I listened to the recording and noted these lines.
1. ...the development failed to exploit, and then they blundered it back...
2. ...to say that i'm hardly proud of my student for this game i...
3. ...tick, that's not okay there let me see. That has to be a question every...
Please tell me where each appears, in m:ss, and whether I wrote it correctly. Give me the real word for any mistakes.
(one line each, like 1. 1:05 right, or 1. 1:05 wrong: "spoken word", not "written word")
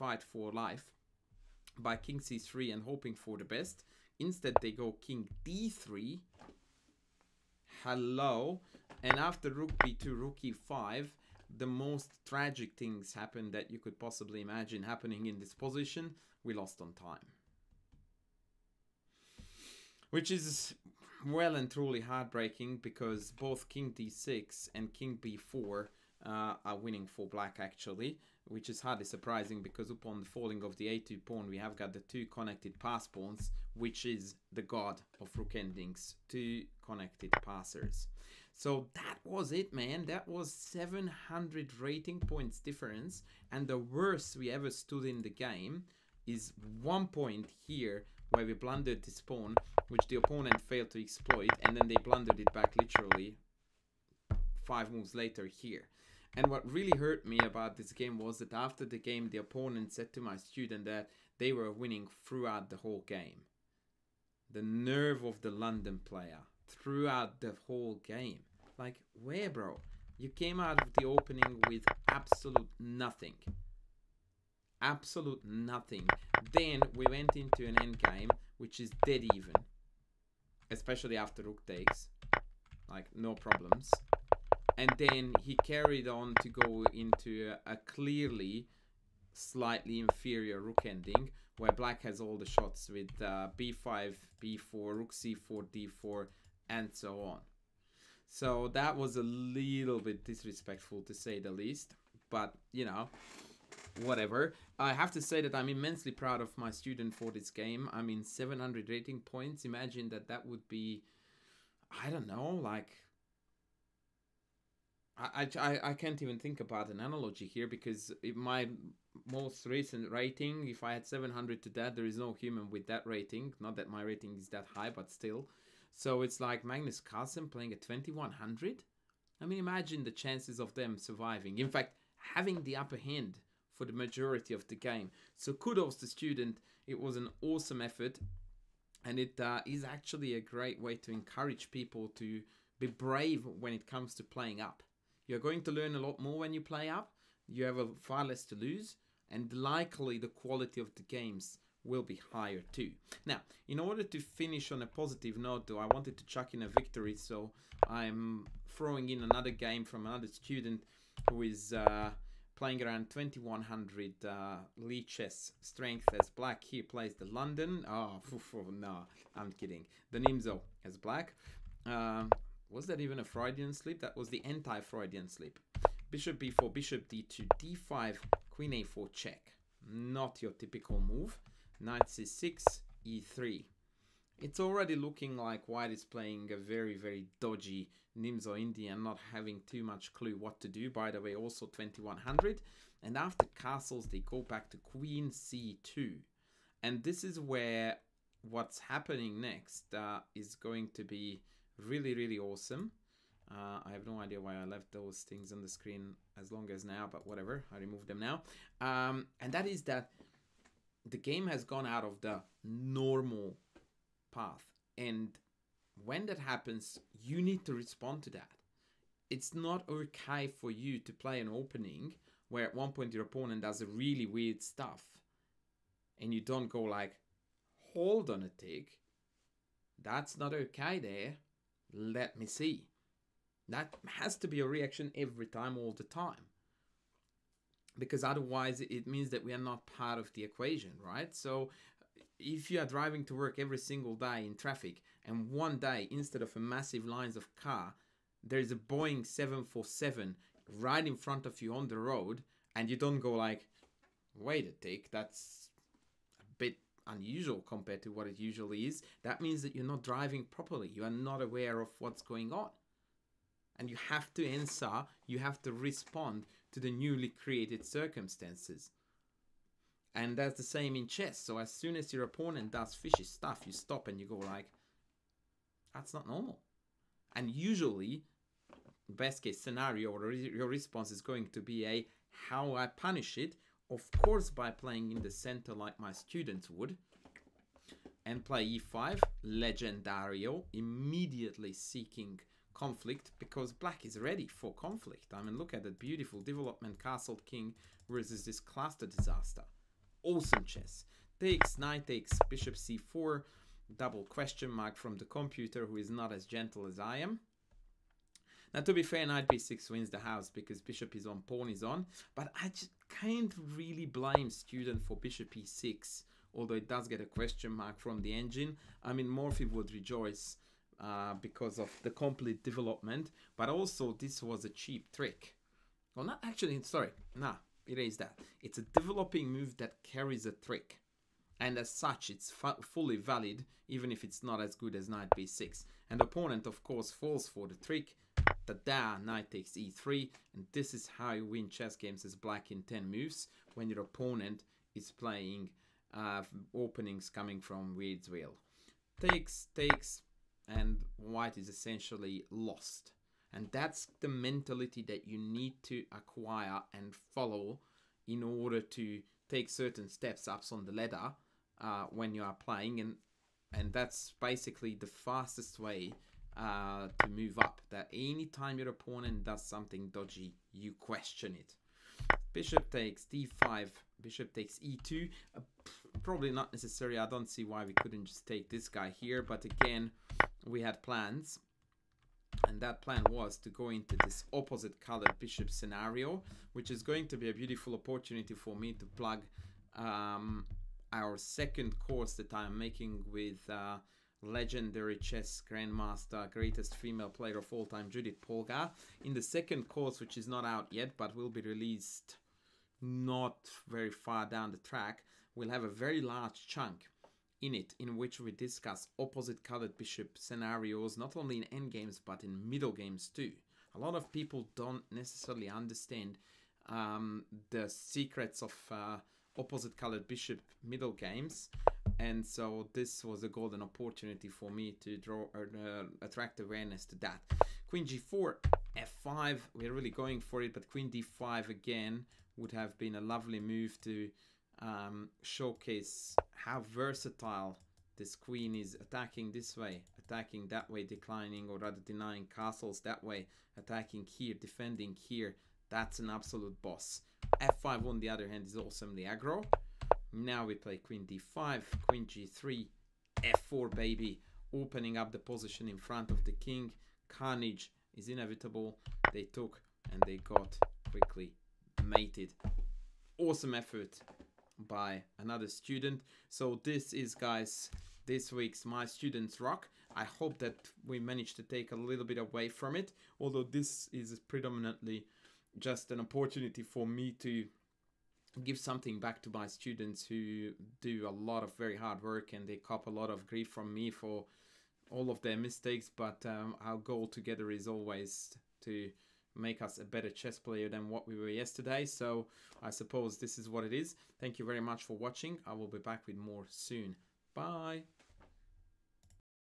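1. 0:50 wrong: "opponent", not "development"
2. 1:45 wrong: "immensely", not "hardly"
3. 3:48 wrong: "reaction", not "question".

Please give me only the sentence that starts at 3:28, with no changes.
Um, and that is that the game has gone out of the normal path.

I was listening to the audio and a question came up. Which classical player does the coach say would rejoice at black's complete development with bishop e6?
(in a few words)
Morphy.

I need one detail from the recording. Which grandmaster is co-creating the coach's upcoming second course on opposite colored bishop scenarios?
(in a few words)
Judith Polgar.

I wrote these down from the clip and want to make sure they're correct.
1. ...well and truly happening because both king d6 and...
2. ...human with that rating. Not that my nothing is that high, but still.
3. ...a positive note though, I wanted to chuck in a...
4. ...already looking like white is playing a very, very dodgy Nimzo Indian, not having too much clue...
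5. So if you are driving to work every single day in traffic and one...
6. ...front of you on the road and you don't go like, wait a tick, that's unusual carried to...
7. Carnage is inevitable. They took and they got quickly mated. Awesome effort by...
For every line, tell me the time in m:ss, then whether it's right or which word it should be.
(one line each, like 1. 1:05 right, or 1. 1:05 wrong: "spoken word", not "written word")
1. 0:21 wrong: "heartbreaking", not "happening"
2. 2:02 wrong: "rating", not "nothing"
3. 2:34 right
4. 3:04 right
5. 4:01 right
6. 4:11 wrong: "compared", not "carried"
7. 7:37 right.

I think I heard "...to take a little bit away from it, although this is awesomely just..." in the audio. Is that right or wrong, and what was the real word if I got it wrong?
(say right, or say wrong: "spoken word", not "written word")
wrong: "predominantly", not "awesomely".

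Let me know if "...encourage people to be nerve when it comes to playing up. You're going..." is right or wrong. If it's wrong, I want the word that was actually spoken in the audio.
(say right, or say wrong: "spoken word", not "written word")
wrong: "brave", not "nerve".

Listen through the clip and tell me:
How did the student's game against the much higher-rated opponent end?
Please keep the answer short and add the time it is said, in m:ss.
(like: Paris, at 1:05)
Lost on time, at 0:16.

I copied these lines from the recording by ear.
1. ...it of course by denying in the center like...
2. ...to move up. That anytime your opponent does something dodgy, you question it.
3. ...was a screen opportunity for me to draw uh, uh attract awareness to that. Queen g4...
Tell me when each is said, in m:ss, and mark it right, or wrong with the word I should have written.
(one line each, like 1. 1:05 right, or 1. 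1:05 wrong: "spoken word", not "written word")
1. 4:43 wrong: "playing", not "denying"
2. 6:07 right
3. 7:03 wrong: "golden", not "screen".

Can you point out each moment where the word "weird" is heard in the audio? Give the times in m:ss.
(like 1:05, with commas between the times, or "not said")
3:44, 5:47.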